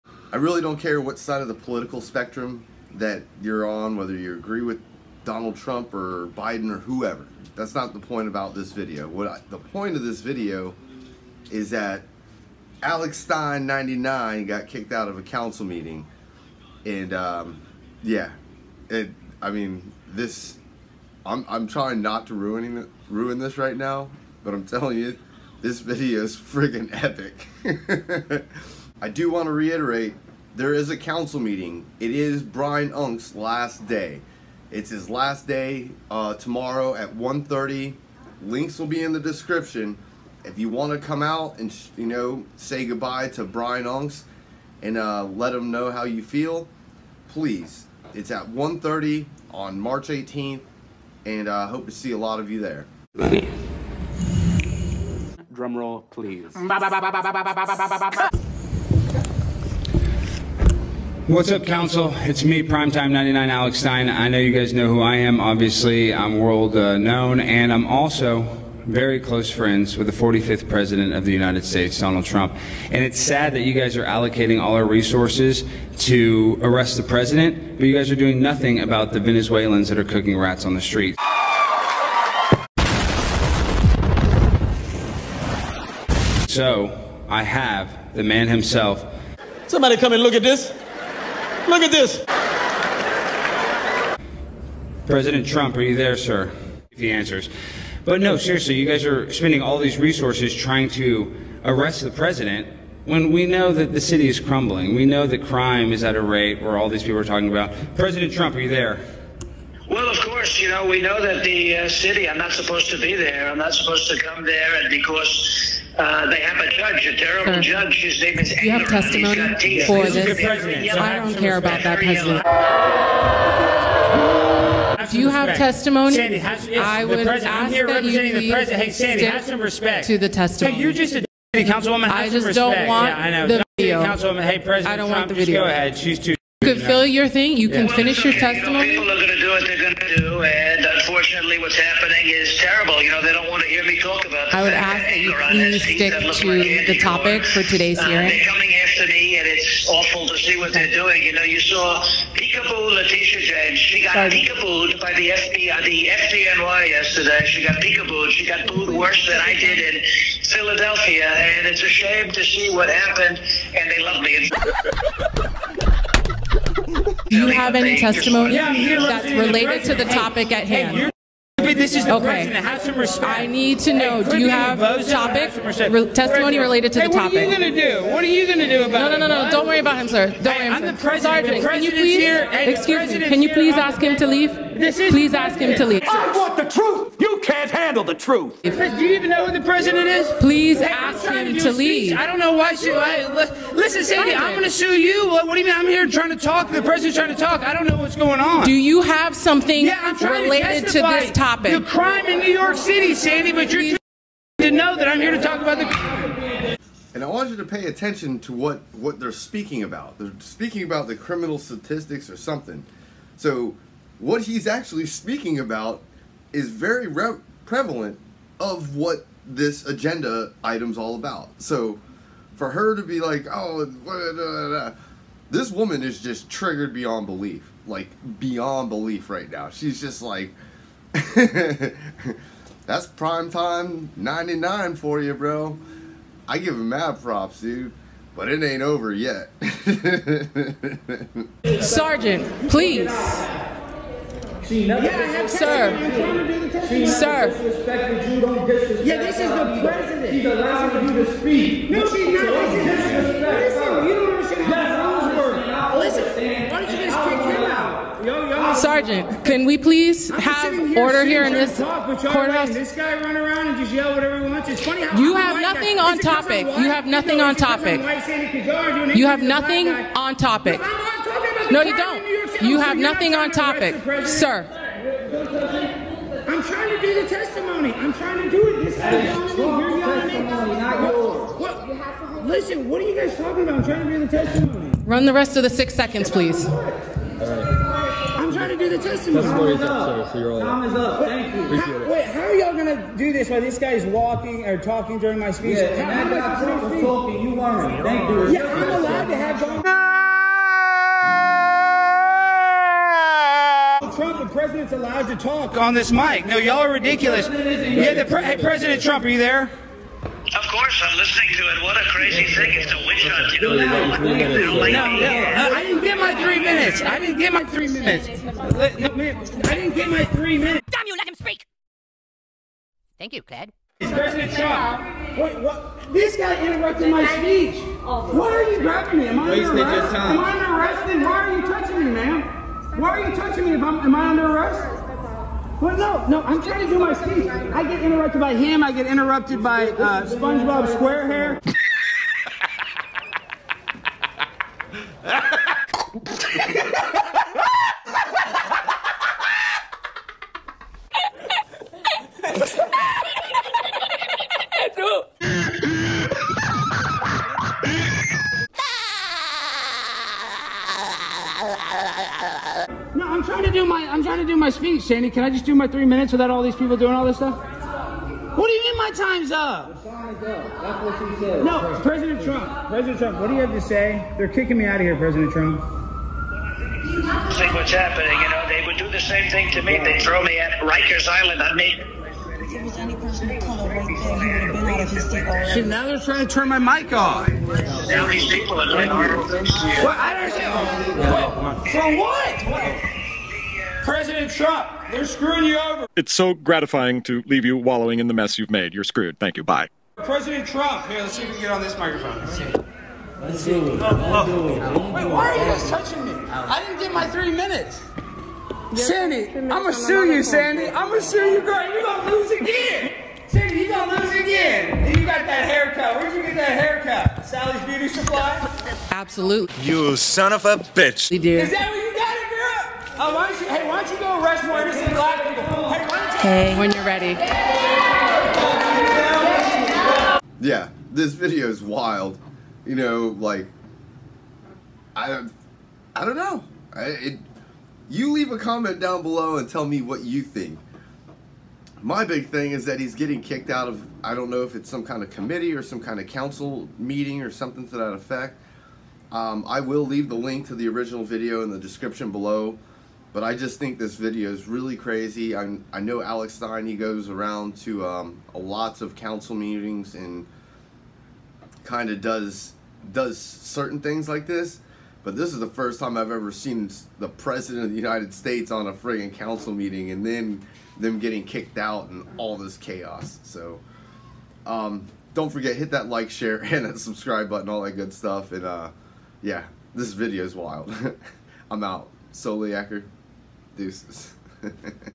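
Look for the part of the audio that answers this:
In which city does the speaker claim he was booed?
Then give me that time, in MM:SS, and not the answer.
02:40.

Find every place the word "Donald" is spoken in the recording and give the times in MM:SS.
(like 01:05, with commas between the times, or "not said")
00:05, 01:11.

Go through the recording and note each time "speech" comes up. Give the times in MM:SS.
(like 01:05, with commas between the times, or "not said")
04:55, 05:27, 05:37, 06:04.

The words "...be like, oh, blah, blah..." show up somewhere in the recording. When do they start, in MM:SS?
03:43.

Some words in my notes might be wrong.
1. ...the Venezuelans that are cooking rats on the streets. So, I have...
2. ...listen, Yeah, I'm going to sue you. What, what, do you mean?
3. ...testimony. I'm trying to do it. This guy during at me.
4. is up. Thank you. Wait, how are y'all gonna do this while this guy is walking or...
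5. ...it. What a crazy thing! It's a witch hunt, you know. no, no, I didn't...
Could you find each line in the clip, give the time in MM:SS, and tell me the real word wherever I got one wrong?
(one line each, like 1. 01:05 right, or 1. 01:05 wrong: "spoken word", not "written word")
1. 01:19 right
2. 03:13 wrong: "Sandy", not "Yeah"
3. 04:37 wrong: "yelling", not "during"
4. 04:49 right
5. 05:11 right.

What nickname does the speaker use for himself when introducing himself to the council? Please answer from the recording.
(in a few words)
Primetime 99.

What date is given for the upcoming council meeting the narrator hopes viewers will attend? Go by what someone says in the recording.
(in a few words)
March 18th.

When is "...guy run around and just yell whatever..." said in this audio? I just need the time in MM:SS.
04:22.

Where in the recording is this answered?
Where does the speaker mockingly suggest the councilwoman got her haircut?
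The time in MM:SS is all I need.
06:57.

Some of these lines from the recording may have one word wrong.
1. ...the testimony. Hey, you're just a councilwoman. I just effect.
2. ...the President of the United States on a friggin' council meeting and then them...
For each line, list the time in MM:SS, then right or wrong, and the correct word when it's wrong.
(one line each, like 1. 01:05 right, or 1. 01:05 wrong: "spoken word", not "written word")
1. 02:10 wrong: "respect", not "effect"
2. 07:47 right.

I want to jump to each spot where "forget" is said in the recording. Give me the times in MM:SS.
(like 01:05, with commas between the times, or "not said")
07:55.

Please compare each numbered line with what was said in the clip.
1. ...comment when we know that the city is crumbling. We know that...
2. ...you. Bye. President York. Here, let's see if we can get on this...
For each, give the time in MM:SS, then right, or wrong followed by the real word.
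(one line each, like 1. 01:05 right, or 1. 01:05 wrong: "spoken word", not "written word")
1. 01:42 wrong: "president", not "comment"
2. 06:39 wrong: "Trump", not "York".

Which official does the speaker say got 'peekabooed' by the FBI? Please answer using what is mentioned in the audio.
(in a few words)
Letitia James.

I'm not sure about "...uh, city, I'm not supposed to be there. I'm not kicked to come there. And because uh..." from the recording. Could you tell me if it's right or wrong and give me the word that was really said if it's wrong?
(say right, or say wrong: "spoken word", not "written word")
wrong: "supposed", not "kicked".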